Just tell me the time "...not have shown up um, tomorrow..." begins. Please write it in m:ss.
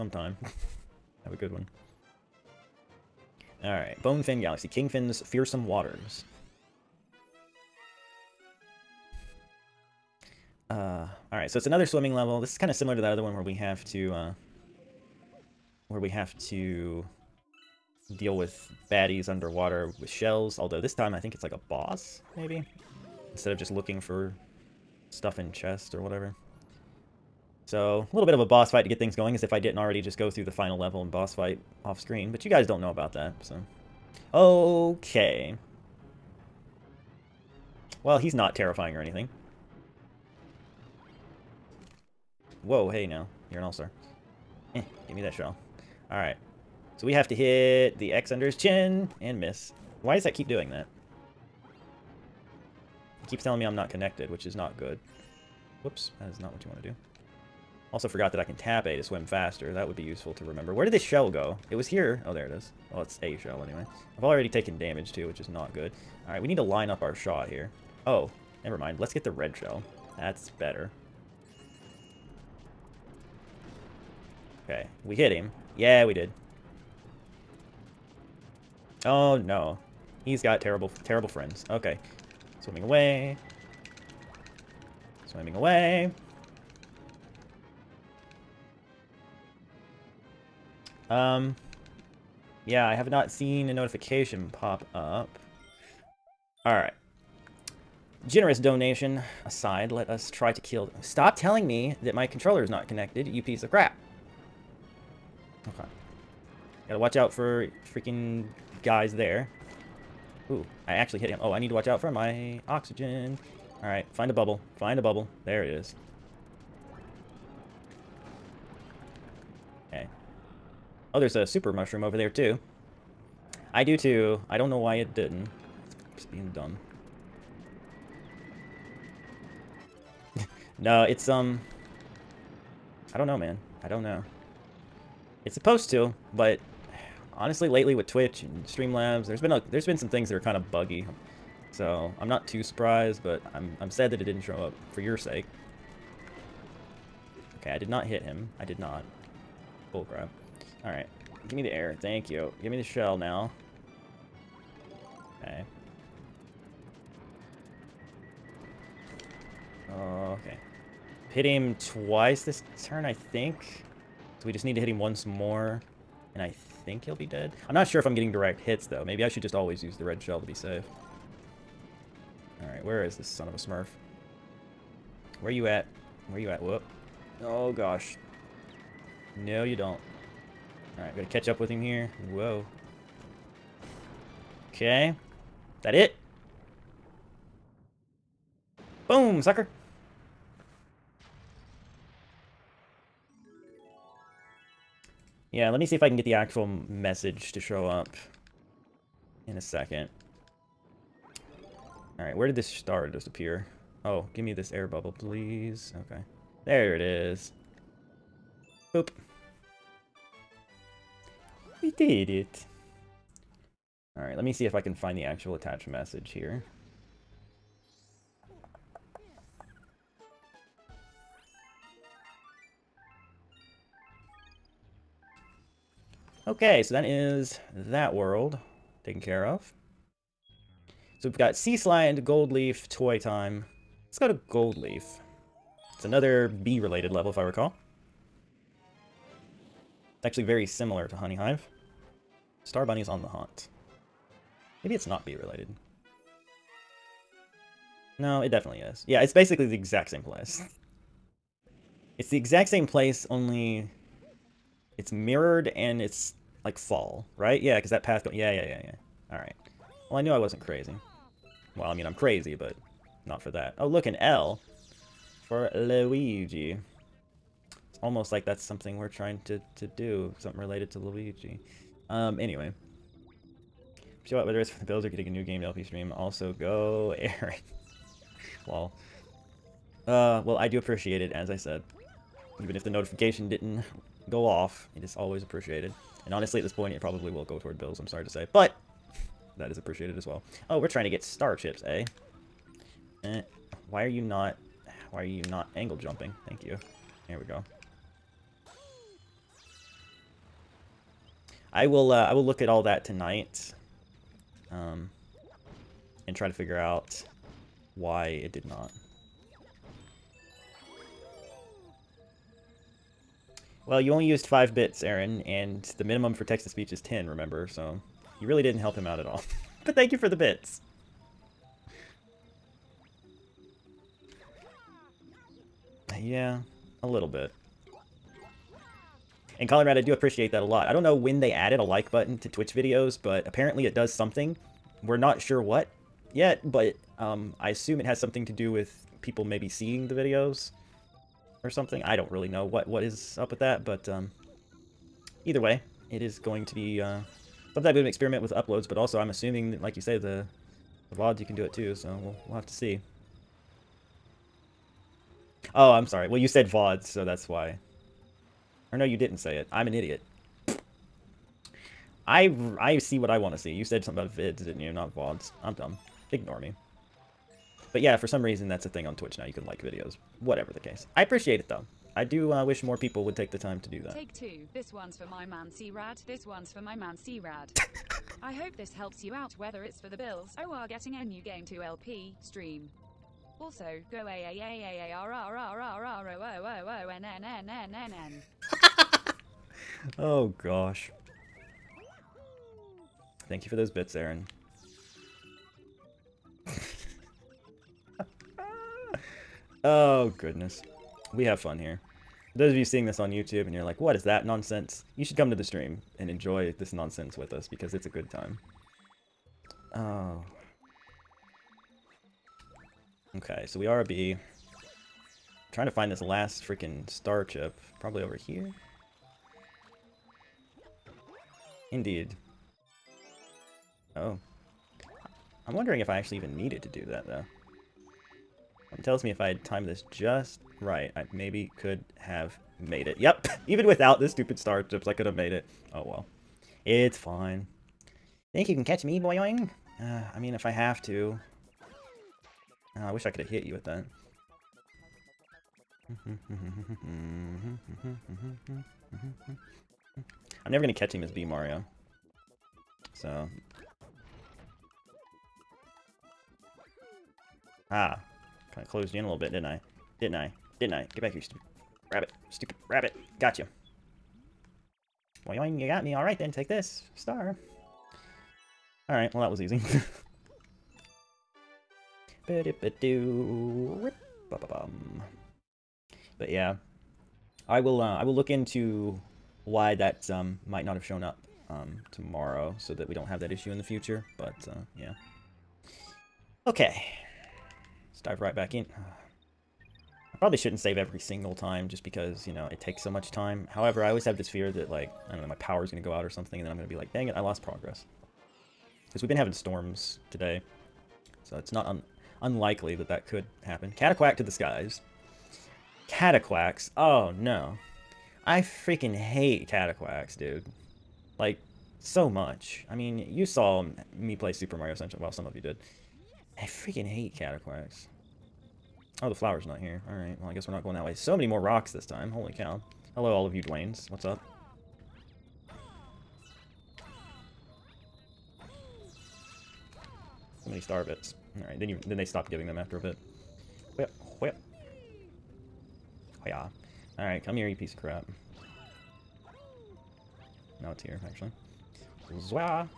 8:00.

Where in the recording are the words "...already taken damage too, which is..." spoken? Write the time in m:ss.
1:04.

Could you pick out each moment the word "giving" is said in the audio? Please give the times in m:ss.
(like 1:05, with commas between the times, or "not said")
8:52.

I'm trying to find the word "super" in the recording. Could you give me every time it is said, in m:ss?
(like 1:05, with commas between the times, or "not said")
2:01, 8:34.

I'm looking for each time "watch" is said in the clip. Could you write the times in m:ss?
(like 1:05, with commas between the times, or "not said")
1:46, 1:51.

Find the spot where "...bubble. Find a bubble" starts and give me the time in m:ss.
1:54.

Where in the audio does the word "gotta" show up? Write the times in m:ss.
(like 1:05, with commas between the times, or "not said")
1:46, 3:01.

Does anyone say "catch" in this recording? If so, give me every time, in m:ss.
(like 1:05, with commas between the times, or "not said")
3:01, 7:18, 7:30.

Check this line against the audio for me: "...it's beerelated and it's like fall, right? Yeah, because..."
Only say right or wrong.
wrong.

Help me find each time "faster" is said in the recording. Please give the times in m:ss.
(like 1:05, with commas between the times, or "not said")
0:59.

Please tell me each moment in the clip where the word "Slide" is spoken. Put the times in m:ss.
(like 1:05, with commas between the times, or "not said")
3:51.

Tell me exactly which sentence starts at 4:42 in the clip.
Even if the notification didn't go off, it is always appreciated.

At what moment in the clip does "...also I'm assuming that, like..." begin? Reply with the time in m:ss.
5:48.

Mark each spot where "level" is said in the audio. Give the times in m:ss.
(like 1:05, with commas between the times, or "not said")
0:12, 0:30, 3:57.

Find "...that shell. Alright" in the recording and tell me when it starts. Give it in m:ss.
0:45.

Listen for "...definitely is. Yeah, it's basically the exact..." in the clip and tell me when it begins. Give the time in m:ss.
4:08.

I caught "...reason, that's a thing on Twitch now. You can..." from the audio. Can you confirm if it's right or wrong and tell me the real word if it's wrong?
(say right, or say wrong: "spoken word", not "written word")
right.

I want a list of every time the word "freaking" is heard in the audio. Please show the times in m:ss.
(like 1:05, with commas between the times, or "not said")
1:47, 6:56, 8:28, 8:36.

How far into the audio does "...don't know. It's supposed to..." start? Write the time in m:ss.
2:13.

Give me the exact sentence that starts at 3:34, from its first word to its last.
All right, let me see if I can find the actual attached message here.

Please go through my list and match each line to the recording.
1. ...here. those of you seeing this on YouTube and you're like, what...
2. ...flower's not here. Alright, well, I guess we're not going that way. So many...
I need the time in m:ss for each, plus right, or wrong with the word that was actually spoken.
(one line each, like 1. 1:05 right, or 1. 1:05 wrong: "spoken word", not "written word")
1. 6:41 right
2. 8:39 right.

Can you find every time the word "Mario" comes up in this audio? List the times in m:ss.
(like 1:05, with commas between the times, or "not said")
7:31, 8:34.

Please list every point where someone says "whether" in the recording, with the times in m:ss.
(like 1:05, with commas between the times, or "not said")
4:34, 6:19.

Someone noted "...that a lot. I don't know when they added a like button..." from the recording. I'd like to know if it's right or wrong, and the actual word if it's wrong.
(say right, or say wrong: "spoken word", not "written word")
right.